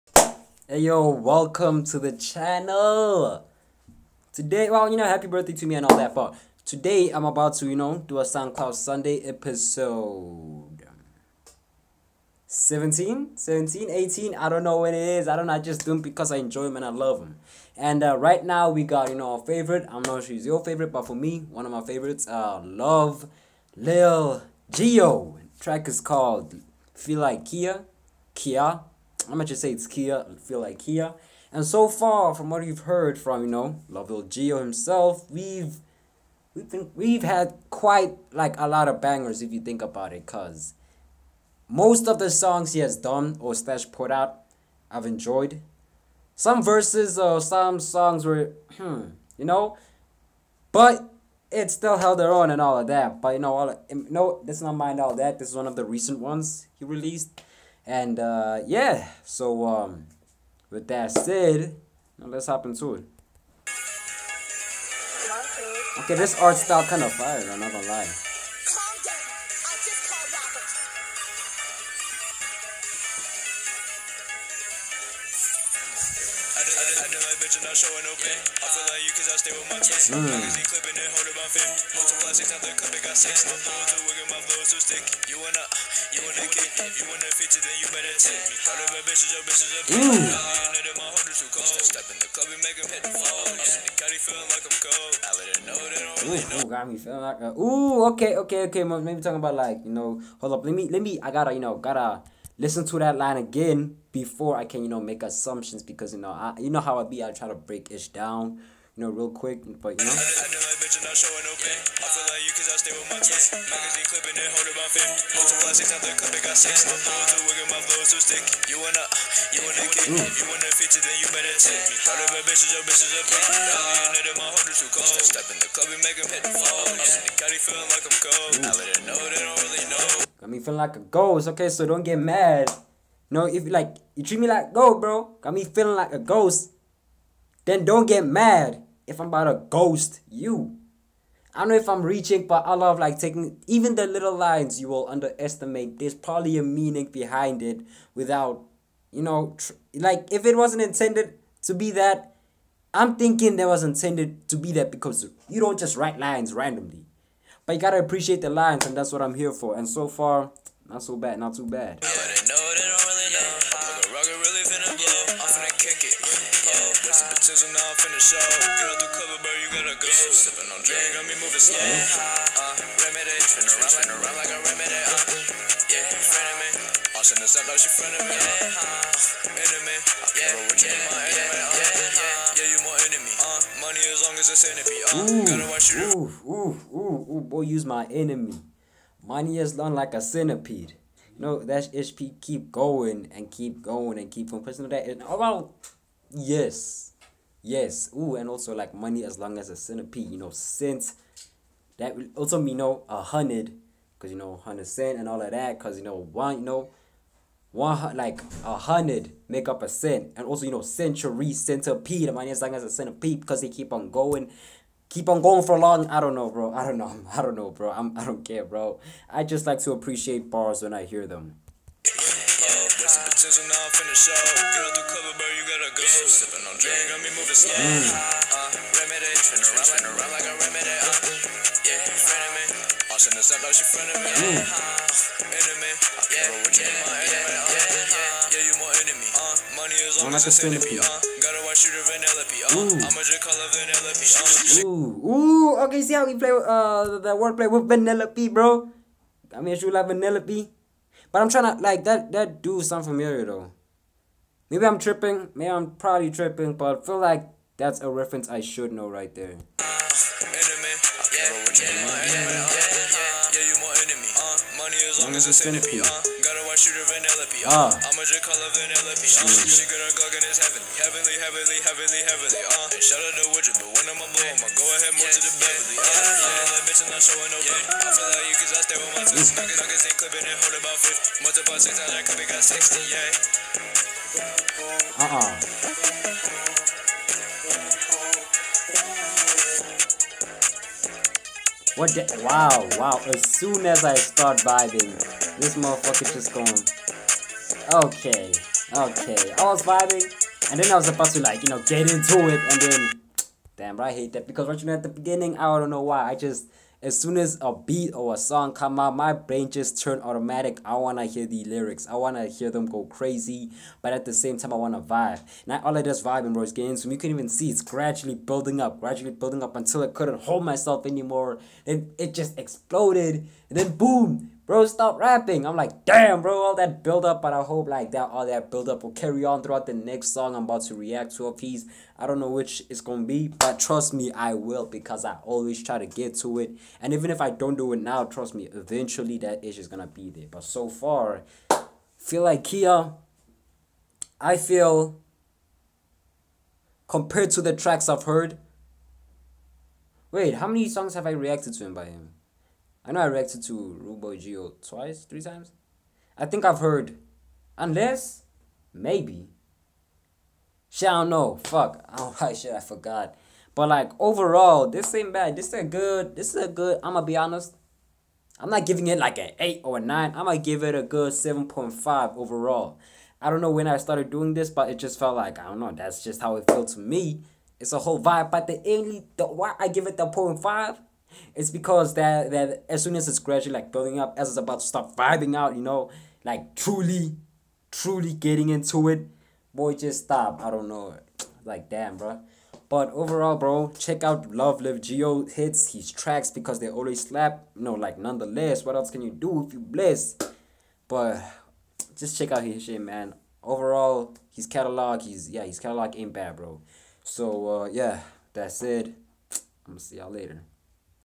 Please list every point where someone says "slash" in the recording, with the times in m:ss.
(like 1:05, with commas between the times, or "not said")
0:43.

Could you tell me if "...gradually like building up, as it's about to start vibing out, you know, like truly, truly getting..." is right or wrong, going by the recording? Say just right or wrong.
right.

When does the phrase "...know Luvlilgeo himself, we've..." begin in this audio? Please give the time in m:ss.
0:33.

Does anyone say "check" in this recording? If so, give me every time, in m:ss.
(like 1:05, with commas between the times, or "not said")
6:33, 6:42.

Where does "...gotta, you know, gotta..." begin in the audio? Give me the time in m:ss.
1:41.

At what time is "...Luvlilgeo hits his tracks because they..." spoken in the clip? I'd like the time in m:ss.
6:34.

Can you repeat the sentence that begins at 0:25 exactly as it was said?
Track is called Feel Like Kya, Kya I'm gonna just say it's Kya.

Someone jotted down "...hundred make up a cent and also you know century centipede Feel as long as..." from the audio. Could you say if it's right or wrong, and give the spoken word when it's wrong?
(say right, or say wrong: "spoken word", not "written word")
wrong: "Money", not "Feel".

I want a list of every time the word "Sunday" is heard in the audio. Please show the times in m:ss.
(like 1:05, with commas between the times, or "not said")
0:08.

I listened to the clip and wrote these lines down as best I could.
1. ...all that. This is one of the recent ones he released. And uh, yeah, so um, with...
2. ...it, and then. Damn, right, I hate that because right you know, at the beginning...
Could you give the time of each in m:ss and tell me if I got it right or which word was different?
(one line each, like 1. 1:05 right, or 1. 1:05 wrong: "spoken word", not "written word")
1. 0:55 right
2. 5:02 right.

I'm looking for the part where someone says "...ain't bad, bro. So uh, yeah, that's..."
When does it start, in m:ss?
6:46.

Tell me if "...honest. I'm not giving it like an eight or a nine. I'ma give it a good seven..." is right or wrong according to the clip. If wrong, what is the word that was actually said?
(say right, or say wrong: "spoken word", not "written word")
right.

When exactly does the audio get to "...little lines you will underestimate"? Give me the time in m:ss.
2:24.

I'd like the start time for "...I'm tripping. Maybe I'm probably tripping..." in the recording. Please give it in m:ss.
4:14.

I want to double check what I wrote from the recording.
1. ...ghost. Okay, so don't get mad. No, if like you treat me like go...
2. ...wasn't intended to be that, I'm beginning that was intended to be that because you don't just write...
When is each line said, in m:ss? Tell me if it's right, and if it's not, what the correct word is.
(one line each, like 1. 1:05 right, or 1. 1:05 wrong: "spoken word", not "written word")
1. 2:10 right
2. 2:30 wrong: "thinking", not "beginning".